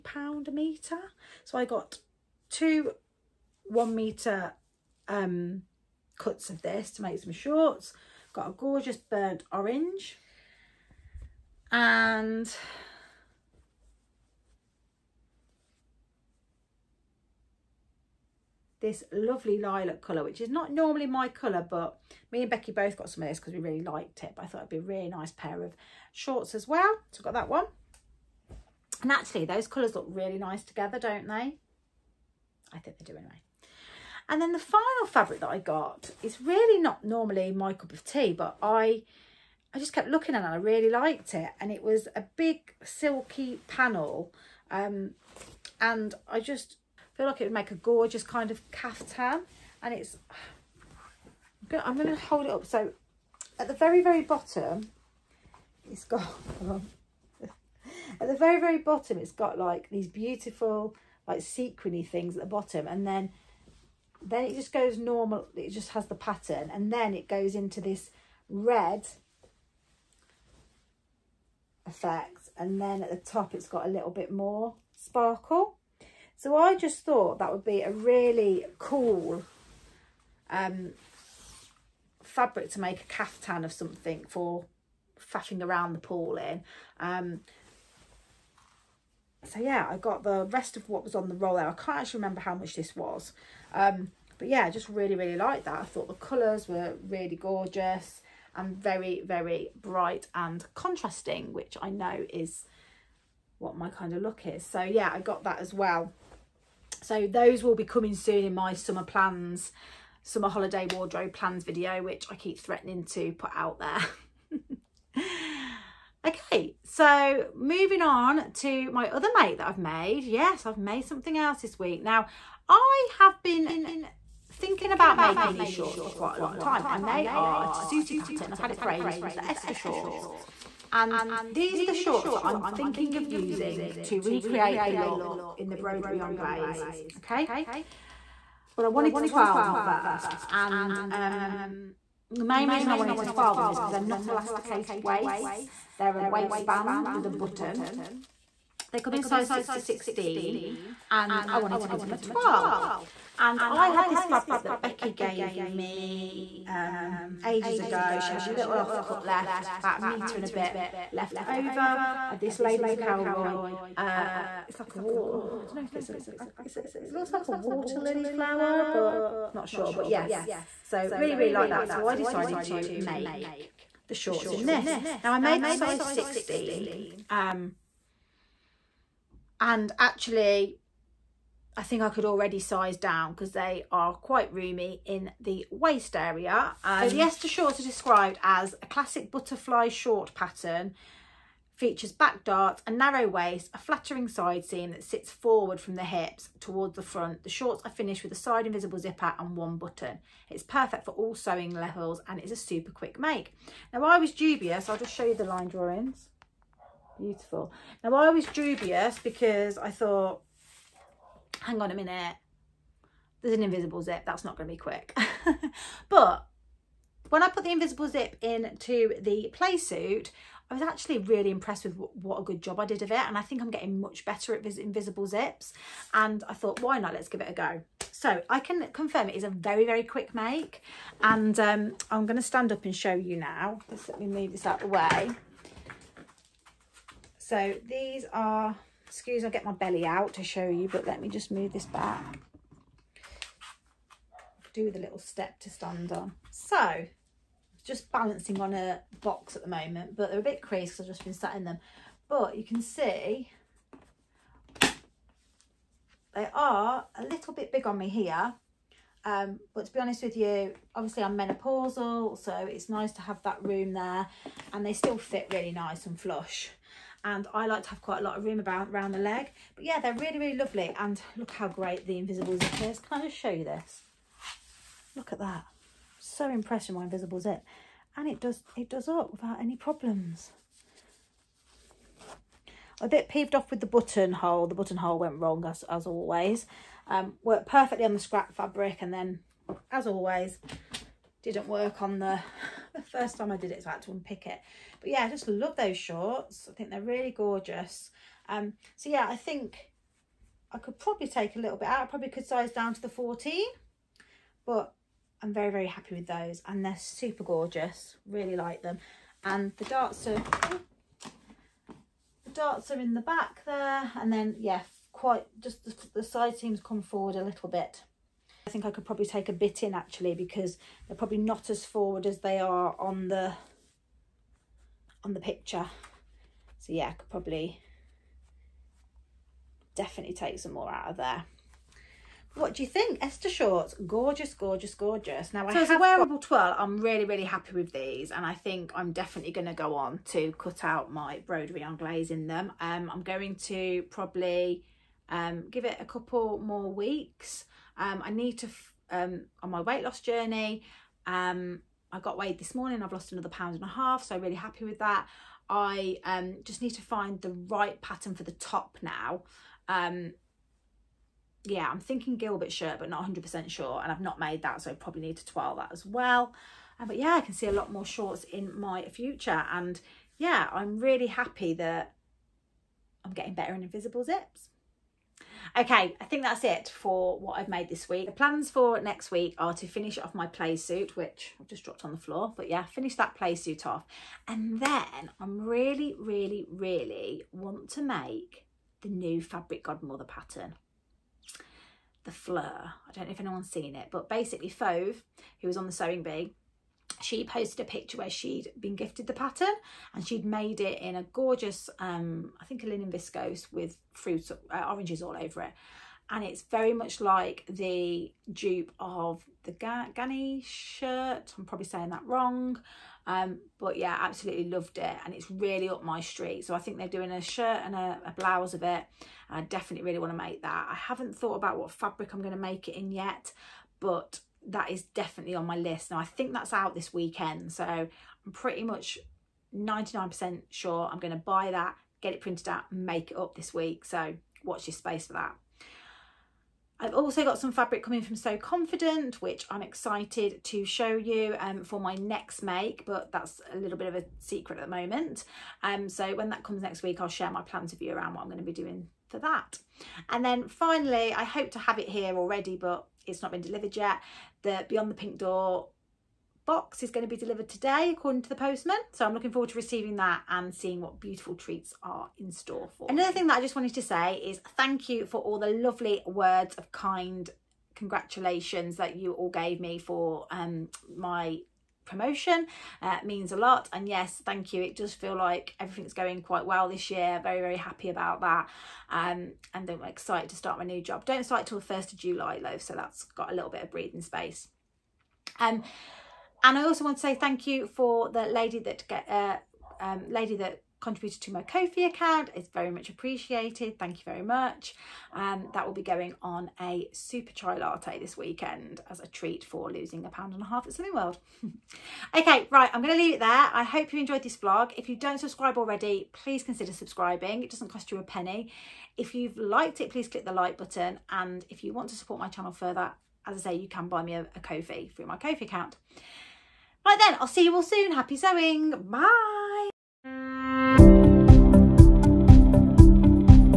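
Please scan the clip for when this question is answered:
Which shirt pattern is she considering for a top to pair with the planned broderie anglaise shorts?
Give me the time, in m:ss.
6:02.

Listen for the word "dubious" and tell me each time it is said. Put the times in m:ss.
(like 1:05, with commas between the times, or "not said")
3:24, 3:28.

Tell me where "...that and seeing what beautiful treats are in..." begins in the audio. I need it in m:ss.
7:40.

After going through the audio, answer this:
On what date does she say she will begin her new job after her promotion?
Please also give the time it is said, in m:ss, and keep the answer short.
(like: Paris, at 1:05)
1 July, at 8:01.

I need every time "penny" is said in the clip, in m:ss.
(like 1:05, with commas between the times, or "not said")
8:28.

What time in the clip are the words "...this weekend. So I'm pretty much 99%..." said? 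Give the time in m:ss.
7:06.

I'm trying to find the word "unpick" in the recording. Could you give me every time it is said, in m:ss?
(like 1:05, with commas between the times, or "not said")
4:54.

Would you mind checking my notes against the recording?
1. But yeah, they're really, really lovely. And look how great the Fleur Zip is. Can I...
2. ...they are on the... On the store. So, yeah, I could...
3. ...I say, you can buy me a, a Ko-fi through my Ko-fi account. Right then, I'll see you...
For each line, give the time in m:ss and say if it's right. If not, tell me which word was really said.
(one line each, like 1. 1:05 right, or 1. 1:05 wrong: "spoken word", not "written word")
1. 4:29 wrong: "Invisible", not "Fleur"
2. 5:22 wrong: "picture", not "store"
3. 8:33 right.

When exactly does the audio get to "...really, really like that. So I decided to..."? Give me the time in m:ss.
2:51.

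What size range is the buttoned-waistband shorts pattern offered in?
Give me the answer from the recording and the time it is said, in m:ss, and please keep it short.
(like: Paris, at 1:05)
6 to 16, at 2:29.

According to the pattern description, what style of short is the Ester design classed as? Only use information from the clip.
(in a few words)
Butterfly short.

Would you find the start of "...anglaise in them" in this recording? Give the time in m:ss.
5:41.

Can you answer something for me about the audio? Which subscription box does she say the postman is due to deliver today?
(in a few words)
Beyond the Pink Door.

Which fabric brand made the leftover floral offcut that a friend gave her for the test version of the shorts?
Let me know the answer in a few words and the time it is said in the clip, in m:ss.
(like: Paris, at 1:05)
Lady McElroy, at 2:42.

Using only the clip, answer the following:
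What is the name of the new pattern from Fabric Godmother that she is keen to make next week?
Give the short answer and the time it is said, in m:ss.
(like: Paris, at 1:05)
Fleur, at 6:32.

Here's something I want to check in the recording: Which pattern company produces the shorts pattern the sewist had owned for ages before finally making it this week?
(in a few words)
Tessuti.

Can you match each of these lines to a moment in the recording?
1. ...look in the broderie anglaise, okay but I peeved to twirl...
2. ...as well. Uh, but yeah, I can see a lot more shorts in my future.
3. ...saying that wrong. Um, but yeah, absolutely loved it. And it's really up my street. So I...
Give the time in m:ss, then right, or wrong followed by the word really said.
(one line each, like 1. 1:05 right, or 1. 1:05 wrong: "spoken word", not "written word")
1. 2:14 wrong: "wanted", not "peeved"
2. 6:05 right
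3. 6:51 right.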